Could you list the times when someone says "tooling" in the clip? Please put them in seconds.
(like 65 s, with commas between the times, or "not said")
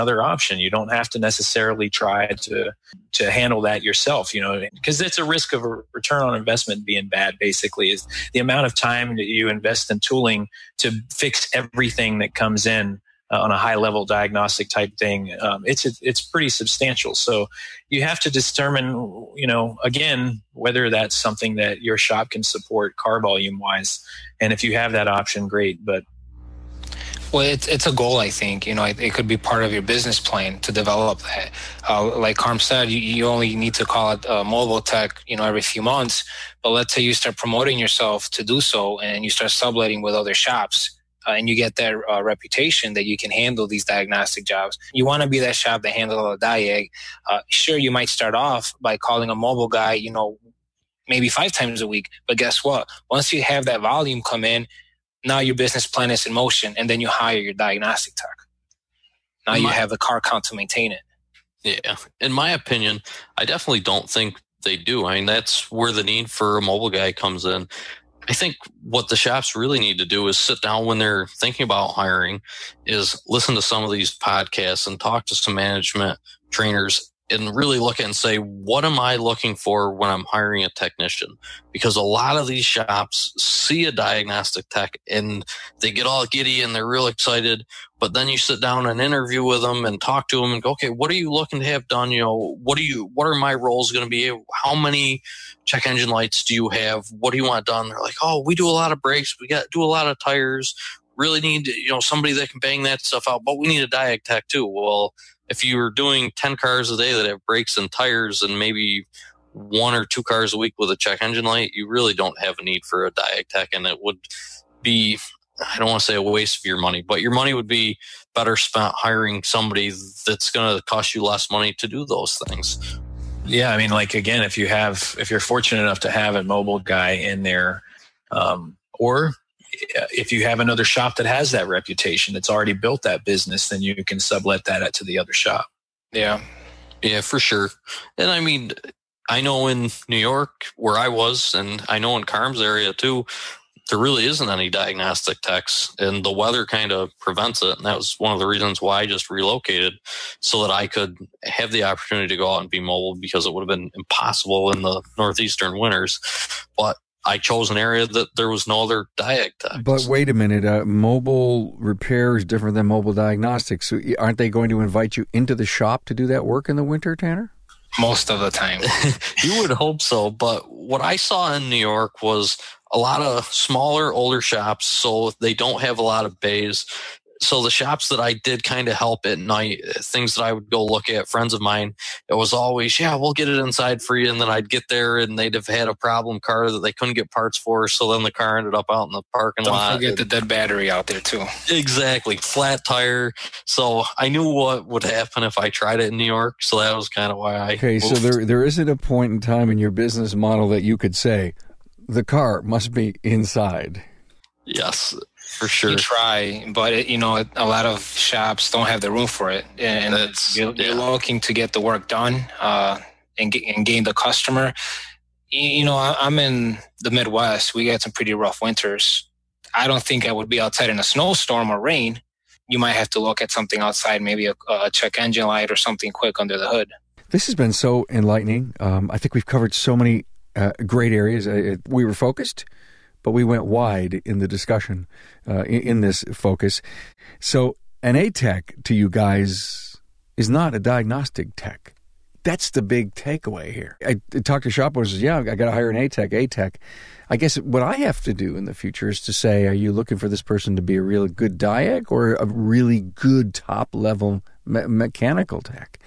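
9 s.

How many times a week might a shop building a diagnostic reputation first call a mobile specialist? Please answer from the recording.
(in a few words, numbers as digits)
5.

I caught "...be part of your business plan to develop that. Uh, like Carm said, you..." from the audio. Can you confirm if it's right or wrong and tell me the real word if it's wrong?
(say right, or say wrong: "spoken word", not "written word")
right.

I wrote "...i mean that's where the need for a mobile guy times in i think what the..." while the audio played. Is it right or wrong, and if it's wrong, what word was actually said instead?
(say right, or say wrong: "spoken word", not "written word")
wrong: "comes", not "times".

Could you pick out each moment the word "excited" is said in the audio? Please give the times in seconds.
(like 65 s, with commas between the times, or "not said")
87 s.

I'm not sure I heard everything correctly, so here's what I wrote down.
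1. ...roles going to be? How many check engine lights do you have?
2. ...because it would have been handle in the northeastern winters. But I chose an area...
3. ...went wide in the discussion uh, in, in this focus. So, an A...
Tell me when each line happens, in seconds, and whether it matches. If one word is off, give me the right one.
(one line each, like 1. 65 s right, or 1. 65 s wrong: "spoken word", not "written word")
1. 93 s right
2. 153 s wrong: "impossible", not "handle"
3. 233 s right.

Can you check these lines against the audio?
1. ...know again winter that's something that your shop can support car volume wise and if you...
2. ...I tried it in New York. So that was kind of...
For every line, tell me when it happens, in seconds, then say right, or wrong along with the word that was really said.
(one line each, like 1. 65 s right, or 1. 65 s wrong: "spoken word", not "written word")
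1. 19 s wrong: "whether", not "winter"
2. 195 s right.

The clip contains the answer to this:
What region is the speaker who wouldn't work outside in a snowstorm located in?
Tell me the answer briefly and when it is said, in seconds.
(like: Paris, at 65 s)
The Midwest, at 217 s.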